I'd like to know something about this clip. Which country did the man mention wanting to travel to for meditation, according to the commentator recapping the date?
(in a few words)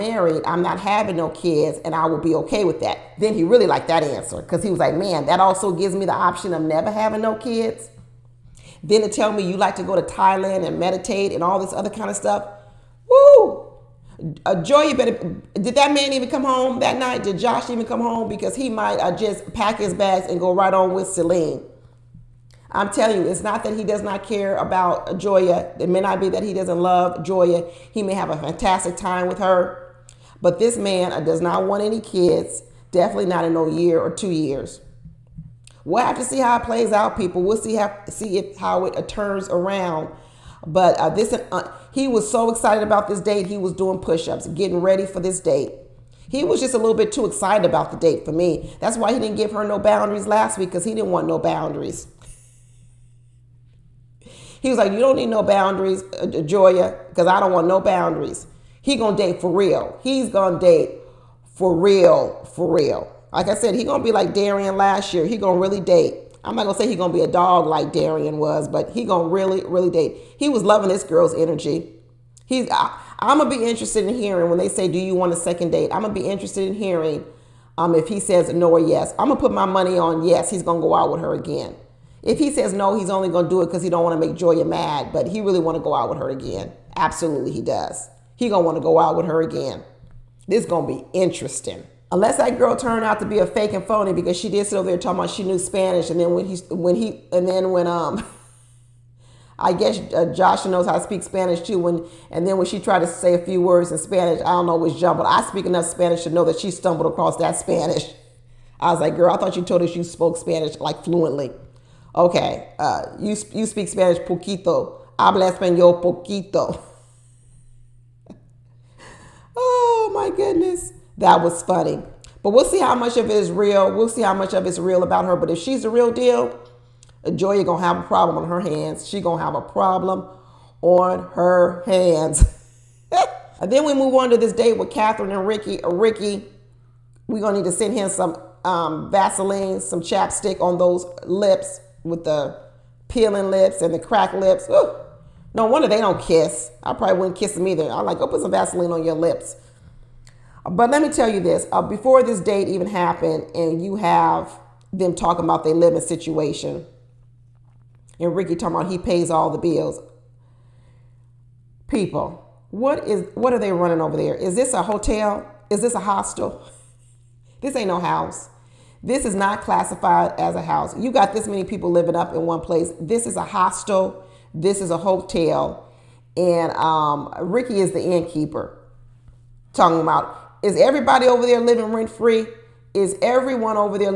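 Thailand.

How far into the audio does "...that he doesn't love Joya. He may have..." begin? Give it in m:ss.
0:26.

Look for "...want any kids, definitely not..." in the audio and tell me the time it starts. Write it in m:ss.
0:31.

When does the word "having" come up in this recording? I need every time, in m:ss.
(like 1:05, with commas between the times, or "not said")
0:00, 0:06.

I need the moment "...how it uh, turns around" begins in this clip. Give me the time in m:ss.
0:38.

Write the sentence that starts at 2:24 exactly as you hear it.
Ooh, no wonder they don't kiss.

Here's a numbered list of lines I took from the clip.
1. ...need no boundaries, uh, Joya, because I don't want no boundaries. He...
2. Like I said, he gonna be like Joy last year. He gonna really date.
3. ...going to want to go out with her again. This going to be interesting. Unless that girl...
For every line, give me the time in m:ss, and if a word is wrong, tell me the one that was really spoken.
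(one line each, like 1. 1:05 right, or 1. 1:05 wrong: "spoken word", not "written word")
1. 0:55 right
2. 1:03 wrong: "Darian", not "Joy"
3. 1:28 right.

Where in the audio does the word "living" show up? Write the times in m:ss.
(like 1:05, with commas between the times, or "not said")
2:35, 2:51, 3:01.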